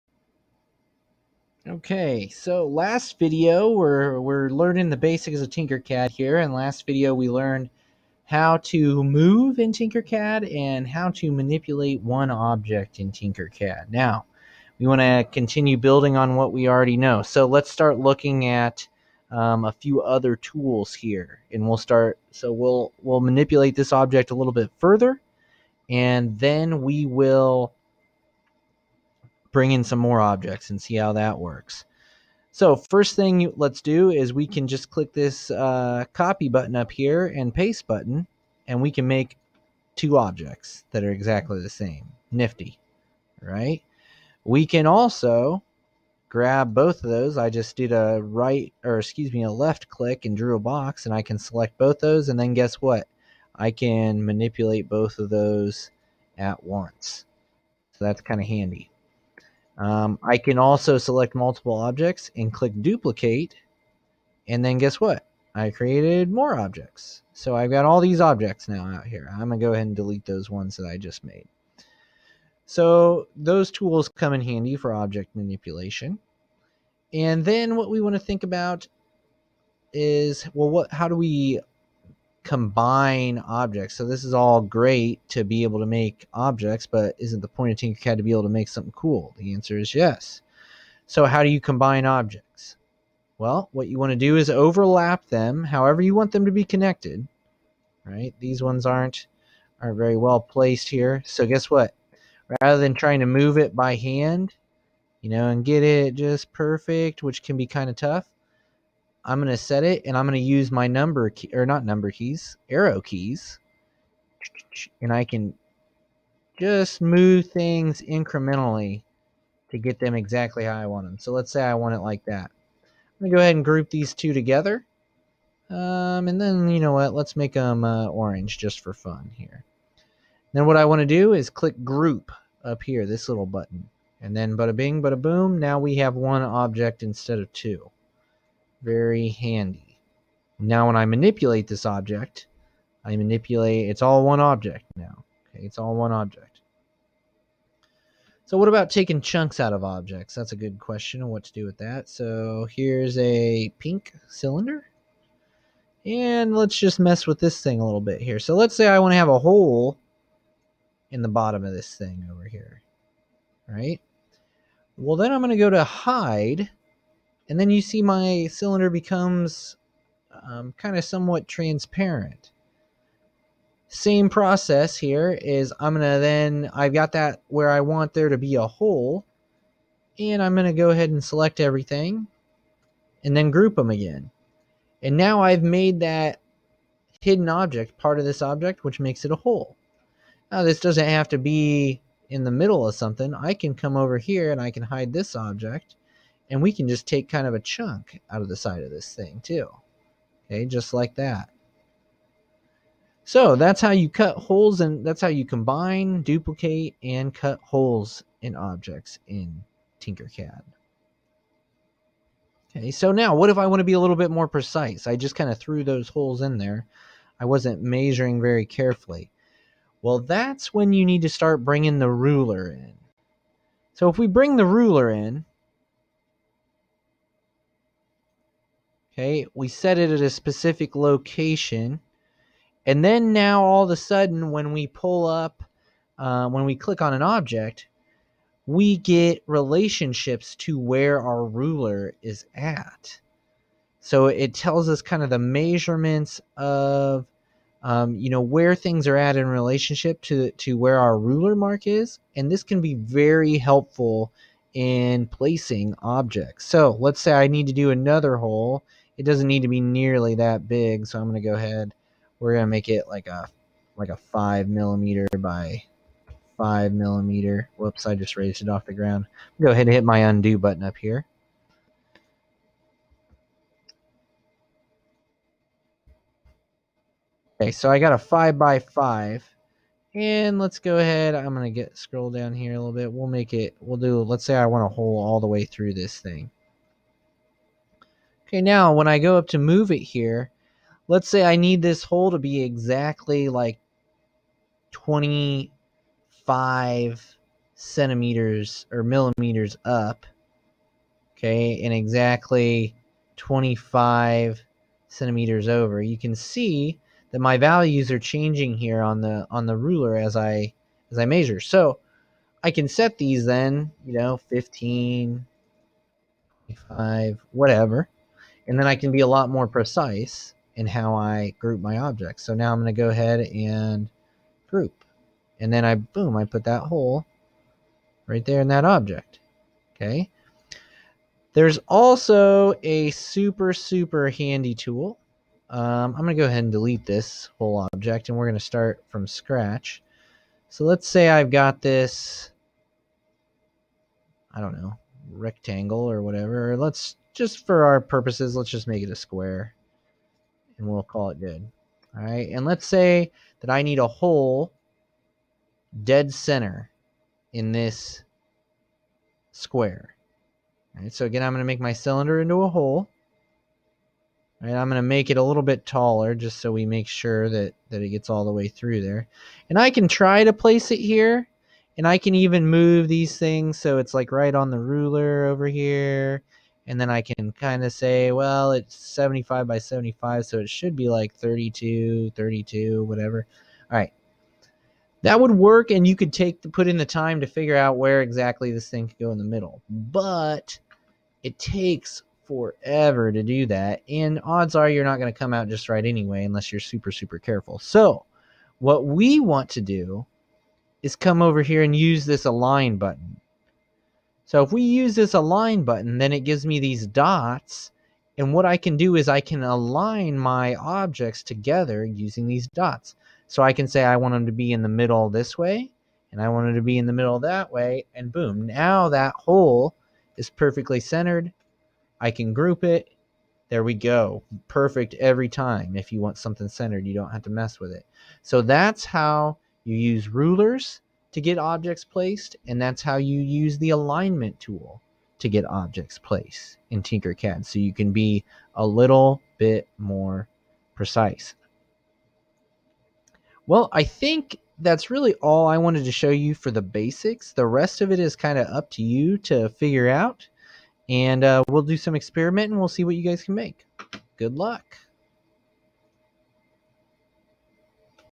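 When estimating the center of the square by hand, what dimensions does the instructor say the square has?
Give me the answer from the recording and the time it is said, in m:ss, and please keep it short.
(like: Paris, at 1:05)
75 by 75, at 6:18.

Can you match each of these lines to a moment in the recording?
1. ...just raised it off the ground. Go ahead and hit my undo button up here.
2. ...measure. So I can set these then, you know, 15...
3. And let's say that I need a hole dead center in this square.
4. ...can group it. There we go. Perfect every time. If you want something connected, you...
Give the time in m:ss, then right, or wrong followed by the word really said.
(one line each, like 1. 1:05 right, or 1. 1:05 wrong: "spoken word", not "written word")
1. 4:28 right
2. 5:11 right
3. 5:52 right
4. 7:02 wrong: "centered", not "connected".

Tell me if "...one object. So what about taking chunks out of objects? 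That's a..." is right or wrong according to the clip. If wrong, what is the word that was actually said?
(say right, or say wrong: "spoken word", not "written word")
right.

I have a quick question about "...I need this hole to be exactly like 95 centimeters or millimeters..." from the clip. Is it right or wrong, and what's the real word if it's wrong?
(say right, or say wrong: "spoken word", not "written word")
wrong: "25", not "95".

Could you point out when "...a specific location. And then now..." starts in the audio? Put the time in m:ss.
3:50.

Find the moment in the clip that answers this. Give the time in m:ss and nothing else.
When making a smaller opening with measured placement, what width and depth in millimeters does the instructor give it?
4:38.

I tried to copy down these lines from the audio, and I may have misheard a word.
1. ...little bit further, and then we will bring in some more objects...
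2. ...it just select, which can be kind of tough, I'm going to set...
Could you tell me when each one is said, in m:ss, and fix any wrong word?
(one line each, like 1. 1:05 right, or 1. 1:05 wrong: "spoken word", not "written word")
1. 0:24 right
2. 1:45 wrong: "perfect", not "select".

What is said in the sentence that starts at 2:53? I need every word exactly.
Same process here is I'm going to then, I've got that where I want there to be a hole.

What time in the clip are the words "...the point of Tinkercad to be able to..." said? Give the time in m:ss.
1:27.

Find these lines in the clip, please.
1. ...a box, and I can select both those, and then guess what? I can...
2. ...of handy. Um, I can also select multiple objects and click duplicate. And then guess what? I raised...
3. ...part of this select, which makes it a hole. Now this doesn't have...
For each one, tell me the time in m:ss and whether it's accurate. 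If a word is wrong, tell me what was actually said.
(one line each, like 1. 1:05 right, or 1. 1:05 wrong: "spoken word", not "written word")
1. 0:50 right
2. 0:58 wrong: "created", not "raised"
3. 3:07 wrong: "object", not "select".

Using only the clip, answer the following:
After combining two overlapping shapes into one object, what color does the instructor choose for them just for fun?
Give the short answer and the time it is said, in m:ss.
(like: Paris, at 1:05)
Orange, at 2:08.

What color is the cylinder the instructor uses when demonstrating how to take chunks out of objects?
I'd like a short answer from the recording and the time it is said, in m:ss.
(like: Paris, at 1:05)
Pink, at 2:33.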